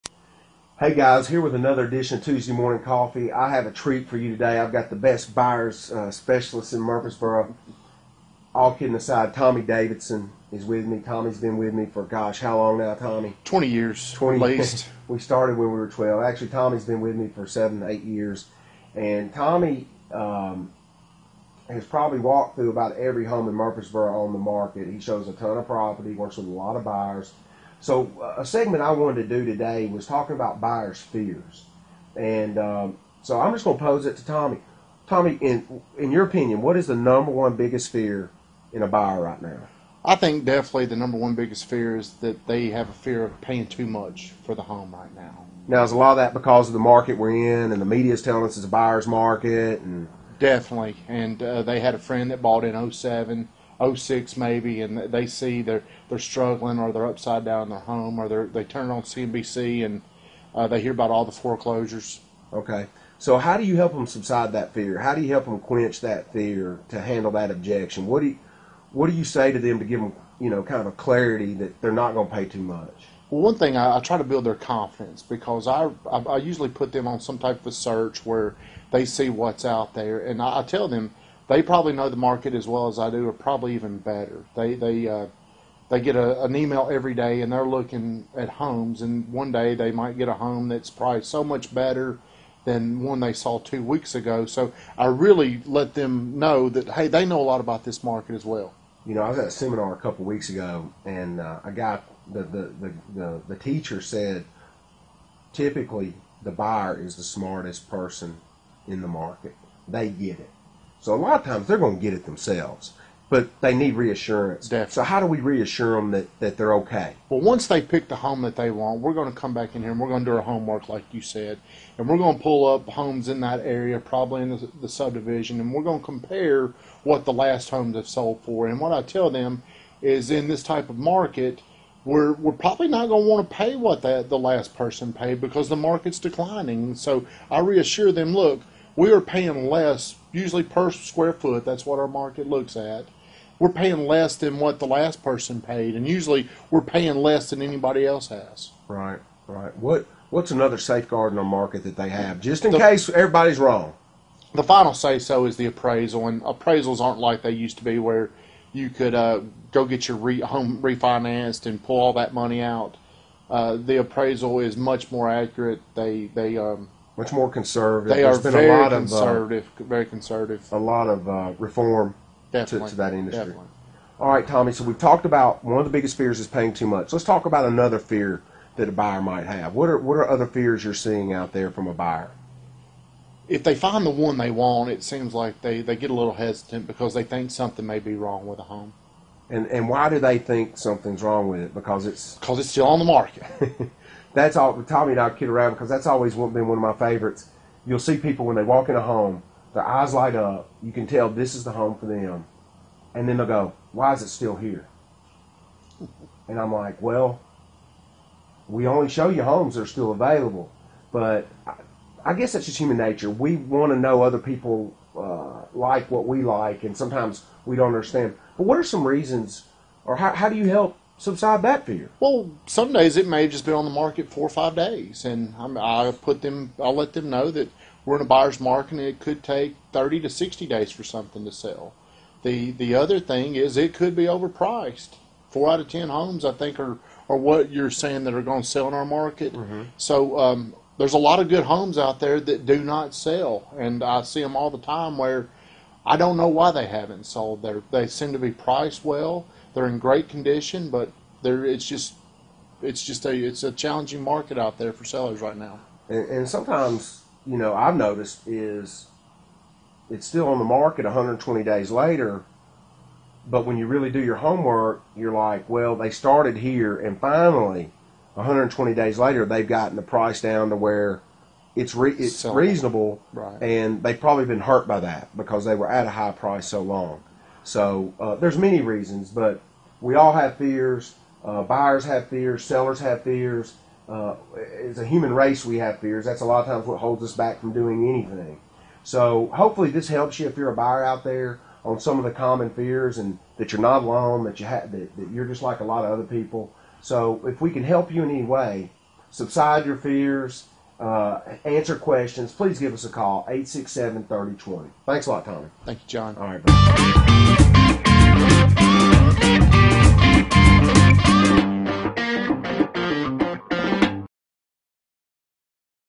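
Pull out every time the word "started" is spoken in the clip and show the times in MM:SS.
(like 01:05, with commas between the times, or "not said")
00:15, 04:26.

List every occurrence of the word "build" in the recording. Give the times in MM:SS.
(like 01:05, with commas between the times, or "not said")
01:14.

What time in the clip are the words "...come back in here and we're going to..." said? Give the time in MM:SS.
01:59.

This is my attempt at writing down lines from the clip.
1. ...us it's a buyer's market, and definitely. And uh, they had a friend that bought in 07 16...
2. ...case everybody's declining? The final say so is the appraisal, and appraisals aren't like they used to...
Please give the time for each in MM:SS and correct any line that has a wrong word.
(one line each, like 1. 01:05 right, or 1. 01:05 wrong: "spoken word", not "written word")
1. 00:48 wrong: "06", not "16"
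2. 02:32 wrong: "wrong", not "declining".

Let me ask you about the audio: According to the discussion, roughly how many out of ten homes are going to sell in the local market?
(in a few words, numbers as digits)
4.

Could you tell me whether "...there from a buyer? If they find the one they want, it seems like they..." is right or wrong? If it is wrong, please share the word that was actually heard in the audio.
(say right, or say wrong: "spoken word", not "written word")
right.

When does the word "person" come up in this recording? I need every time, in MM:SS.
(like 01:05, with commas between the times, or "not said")
01:47, 02:14, 02:25.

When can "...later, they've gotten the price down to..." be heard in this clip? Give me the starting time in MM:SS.
04:29.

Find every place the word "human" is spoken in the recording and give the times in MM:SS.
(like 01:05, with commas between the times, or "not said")
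03:32, 04:45.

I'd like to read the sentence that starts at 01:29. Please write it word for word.
And one day they might get a home that's priced so much better than one they saw two weeks ago.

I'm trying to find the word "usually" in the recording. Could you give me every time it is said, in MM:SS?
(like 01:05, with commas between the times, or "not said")
01:16, 02:20, 02:26.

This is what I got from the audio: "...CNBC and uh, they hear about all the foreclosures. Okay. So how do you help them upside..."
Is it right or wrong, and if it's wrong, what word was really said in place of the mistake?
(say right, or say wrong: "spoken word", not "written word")
wrong: "subside", not "upside".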